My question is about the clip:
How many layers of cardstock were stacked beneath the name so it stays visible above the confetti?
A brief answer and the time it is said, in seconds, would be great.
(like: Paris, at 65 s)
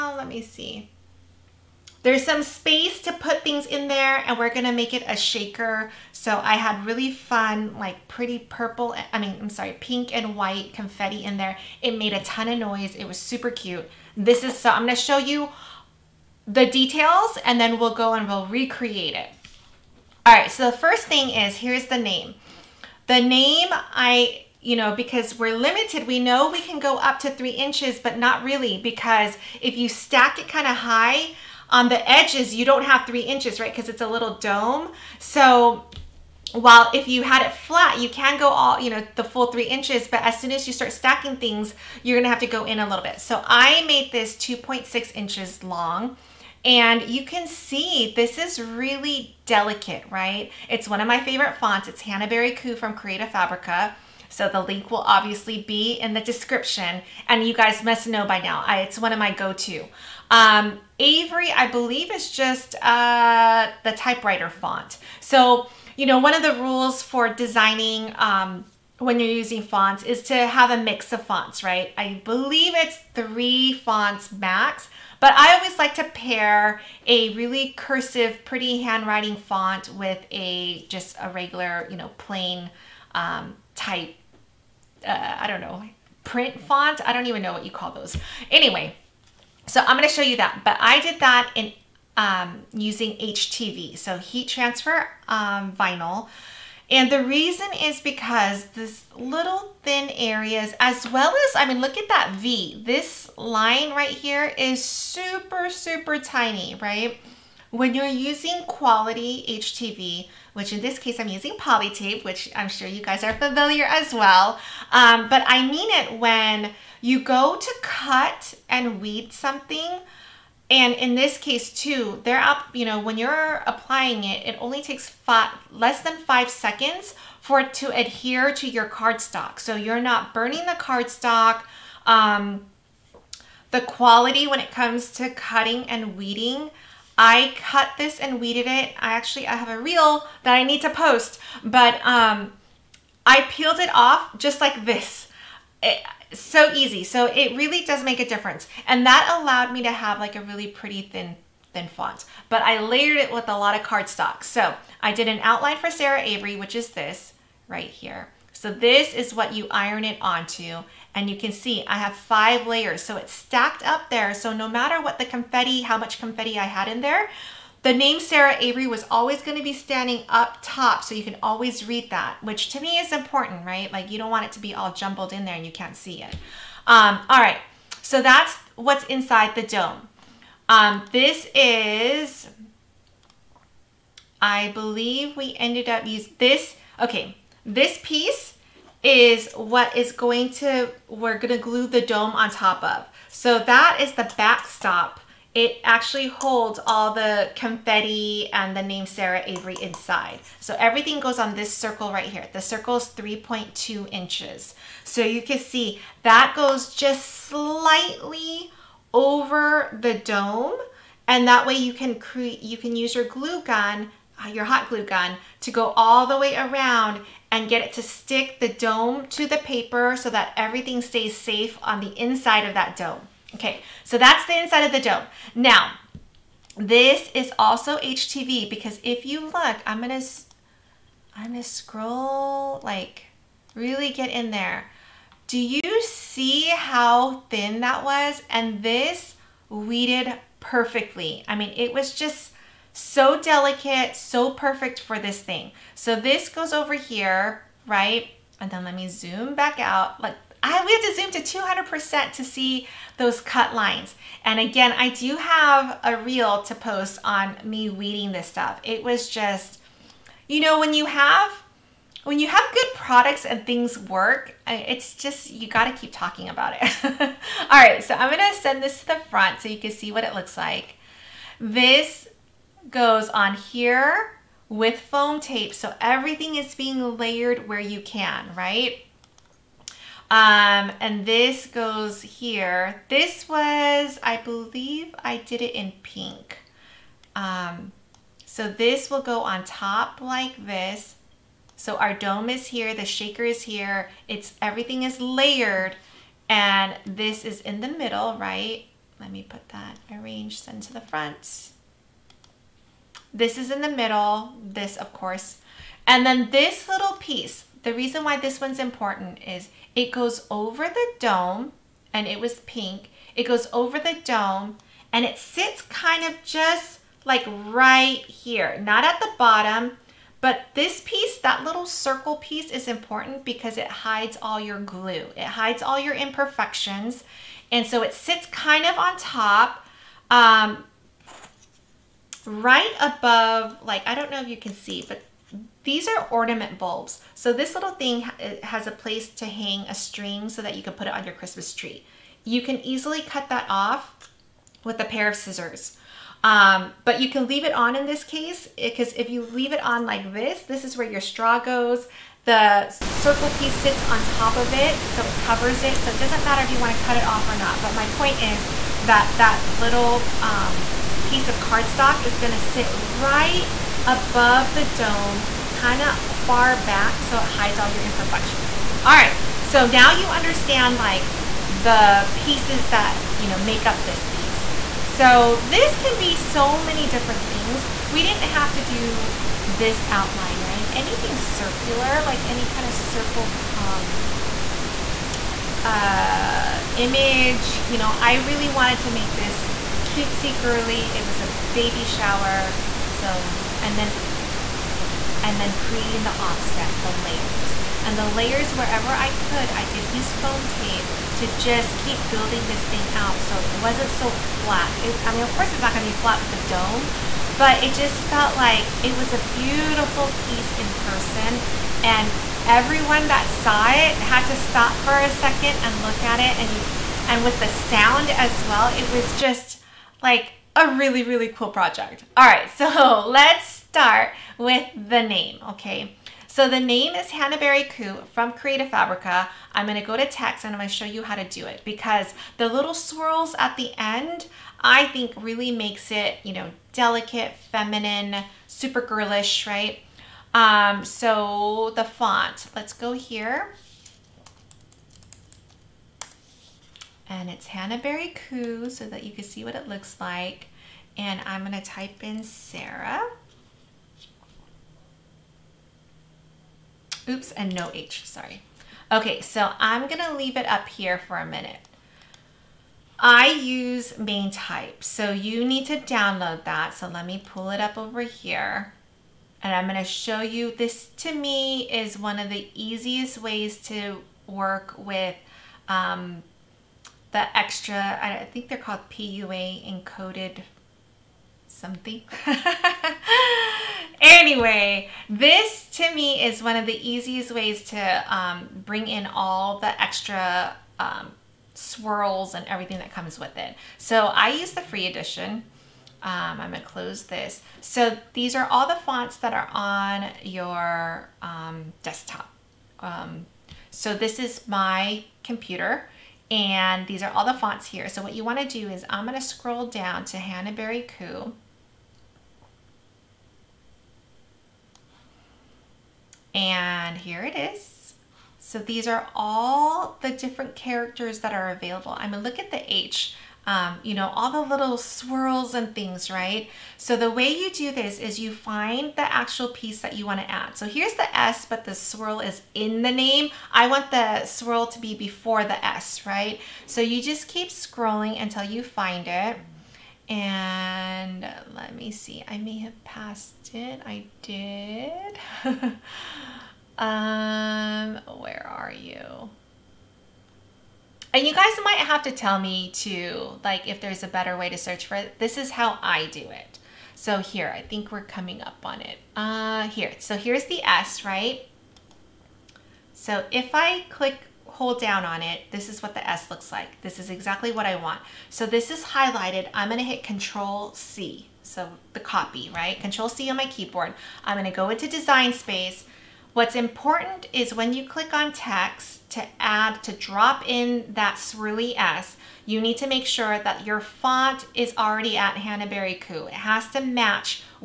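5, at 162 s.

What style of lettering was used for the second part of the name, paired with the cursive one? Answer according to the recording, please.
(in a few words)
typewriter font.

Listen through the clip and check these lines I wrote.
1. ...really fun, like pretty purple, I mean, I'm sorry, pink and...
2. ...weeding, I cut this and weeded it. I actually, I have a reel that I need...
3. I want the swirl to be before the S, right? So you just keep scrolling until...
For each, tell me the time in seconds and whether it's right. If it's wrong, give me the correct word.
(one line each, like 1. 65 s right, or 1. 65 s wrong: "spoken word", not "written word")
1. 6 s right
2. 136 s right
3. 533 s right.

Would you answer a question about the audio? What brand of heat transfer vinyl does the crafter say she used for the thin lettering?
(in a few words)
Poli-Tape.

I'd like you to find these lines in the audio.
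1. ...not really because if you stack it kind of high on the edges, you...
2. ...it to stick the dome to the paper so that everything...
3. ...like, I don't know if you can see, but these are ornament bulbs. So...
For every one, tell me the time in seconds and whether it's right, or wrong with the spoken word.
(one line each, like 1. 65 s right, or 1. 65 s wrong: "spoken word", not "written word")
1. 28 s right
2. 217 s right
3. 333 s right.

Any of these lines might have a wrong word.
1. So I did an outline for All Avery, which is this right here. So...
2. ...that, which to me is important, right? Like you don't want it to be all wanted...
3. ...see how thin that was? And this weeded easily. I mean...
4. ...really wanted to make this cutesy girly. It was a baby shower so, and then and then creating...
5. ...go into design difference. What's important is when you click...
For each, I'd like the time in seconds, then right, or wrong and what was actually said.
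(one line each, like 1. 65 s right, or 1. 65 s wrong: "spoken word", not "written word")
1. 154 s wrong: "Sarah", not "All"
2. 172 s wrong: "jumbled", not "wanted"
3. 236 s wrong: "perfectly", not "easily"
4. 388 s right
5. 574 s wrong: "space", not "difference".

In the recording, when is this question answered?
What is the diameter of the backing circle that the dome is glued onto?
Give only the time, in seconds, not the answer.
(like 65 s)
203 s.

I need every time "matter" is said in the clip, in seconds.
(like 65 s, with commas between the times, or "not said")
164 s, 356 s.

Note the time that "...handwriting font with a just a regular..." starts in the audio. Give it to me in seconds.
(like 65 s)
78 s.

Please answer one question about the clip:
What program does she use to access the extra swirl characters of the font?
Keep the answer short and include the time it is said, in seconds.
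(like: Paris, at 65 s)
MainType, at 464 s.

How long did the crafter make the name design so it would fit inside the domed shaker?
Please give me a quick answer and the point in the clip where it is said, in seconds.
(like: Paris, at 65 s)
2.6 inches, at 44 s.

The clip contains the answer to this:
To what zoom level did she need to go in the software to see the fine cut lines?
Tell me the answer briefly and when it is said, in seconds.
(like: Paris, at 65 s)
200%, at 251 s.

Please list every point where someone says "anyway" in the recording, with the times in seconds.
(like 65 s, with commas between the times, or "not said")
88 s, 484 s.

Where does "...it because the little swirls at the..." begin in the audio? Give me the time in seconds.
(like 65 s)
431 s.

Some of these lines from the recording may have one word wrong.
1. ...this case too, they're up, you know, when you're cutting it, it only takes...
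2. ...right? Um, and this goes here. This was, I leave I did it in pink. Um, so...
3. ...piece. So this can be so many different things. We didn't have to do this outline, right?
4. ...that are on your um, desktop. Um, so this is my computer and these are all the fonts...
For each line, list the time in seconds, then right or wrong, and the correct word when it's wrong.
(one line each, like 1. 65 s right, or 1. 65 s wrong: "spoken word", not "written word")
1. 121 s wrong: "applying", not "cutting"
2. 278 s wrong: "believe", not "leave"
3. 374 s right
4. 499 s right.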